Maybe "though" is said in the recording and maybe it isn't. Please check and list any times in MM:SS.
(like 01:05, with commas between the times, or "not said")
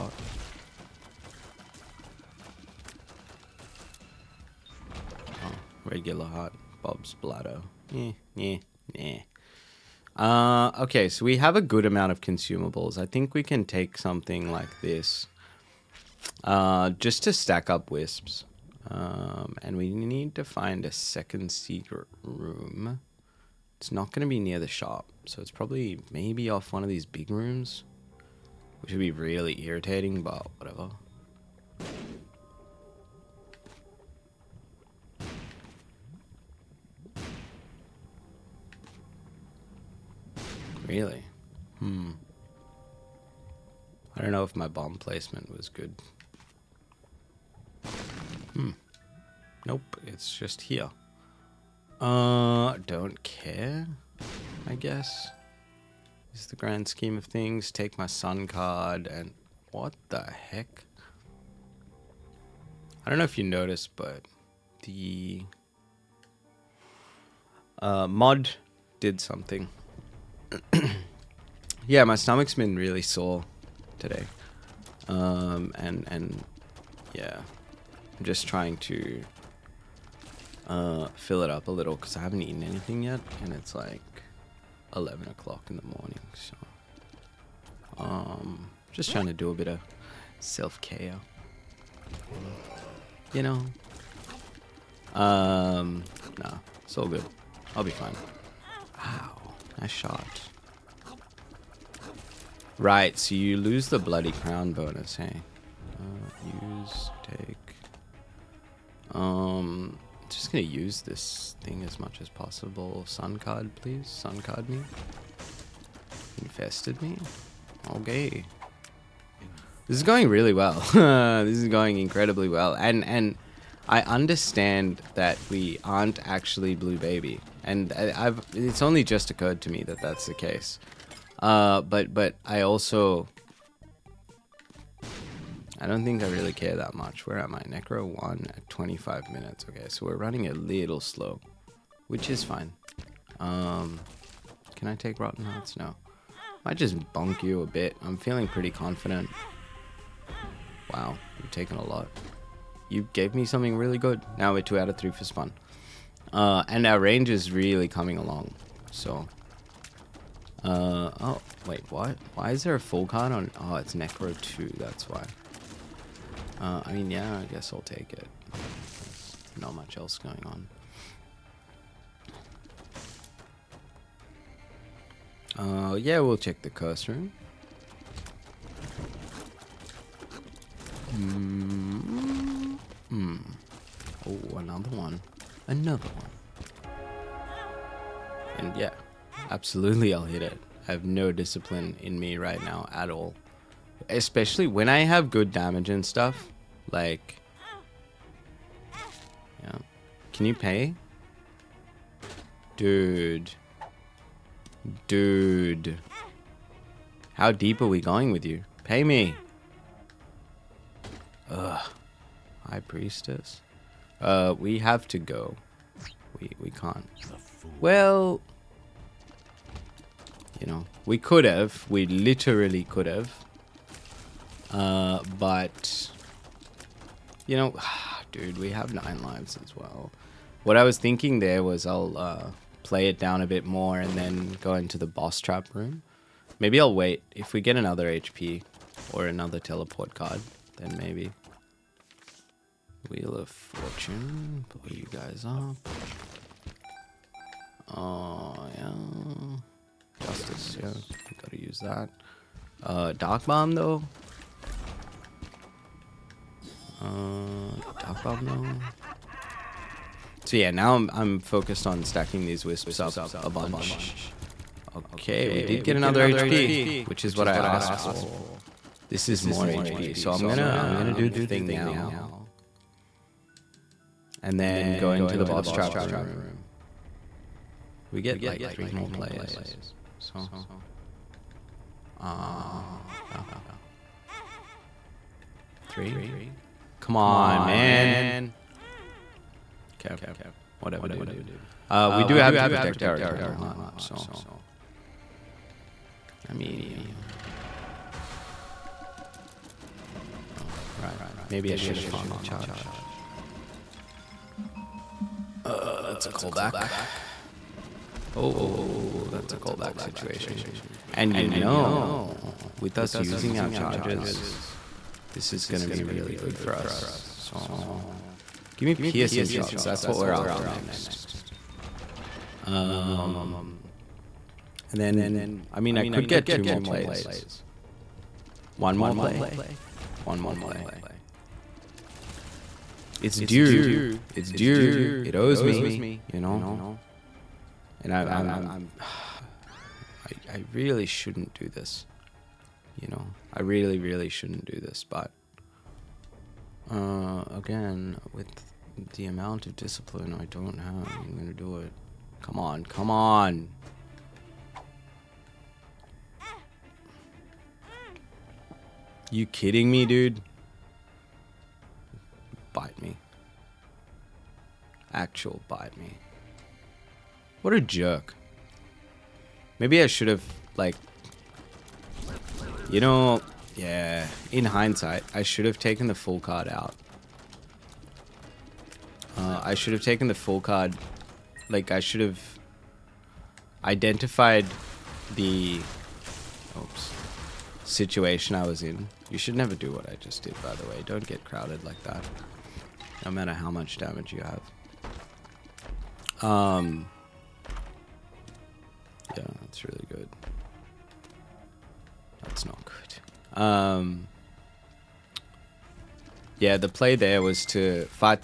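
04:13, 04:18.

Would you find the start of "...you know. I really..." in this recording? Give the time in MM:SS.
05:43.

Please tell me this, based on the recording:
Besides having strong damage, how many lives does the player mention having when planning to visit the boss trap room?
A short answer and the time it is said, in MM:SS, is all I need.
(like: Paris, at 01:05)
nine, at 03:48.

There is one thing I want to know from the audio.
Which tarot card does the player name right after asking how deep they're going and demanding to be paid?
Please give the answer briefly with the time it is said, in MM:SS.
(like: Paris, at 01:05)
High Priestess, at 03:32.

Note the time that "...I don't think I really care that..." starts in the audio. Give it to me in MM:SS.
02:15.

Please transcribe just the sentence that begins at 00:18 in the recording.
Um, and we need to find a second secret room.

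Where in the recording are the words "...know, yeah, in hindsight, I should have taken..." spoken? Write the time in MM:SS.
06:13.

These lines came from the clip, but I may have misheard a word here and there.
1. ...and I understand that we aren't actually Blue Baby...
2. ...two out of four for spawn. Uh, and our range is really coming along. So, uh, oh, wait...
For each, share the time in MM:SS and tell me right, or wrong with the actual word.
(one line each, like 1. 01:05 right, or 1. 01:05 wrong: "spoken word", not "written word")
1. 02:03 right
2. 02:34 wrong: "three", not "four".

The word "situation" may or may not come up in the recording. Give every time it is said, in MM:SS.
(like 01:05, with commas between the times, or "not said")
05:10, 06:27.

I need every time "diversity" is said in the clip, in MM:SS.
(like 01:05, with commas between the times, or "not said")
not said.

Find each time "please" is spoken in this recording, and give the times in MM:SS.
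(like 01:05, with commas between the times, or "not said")
01:53.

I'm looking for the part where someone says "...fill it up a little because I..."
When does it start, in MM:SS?
01:21.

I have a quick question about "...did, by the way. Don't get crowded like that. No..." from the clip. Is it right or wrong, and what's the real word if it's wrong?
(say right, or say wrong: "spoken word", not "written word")
right.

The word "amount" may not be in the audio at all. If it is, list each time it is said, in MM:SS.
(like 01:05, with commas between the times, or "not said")
00:11, 05:49.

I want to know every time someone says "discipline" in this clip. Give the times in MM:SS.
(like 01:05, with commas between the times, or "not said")
03:11, 05:49.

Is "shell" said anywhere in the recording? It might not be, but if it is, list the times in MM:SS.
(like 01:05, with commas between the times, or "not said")
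not said.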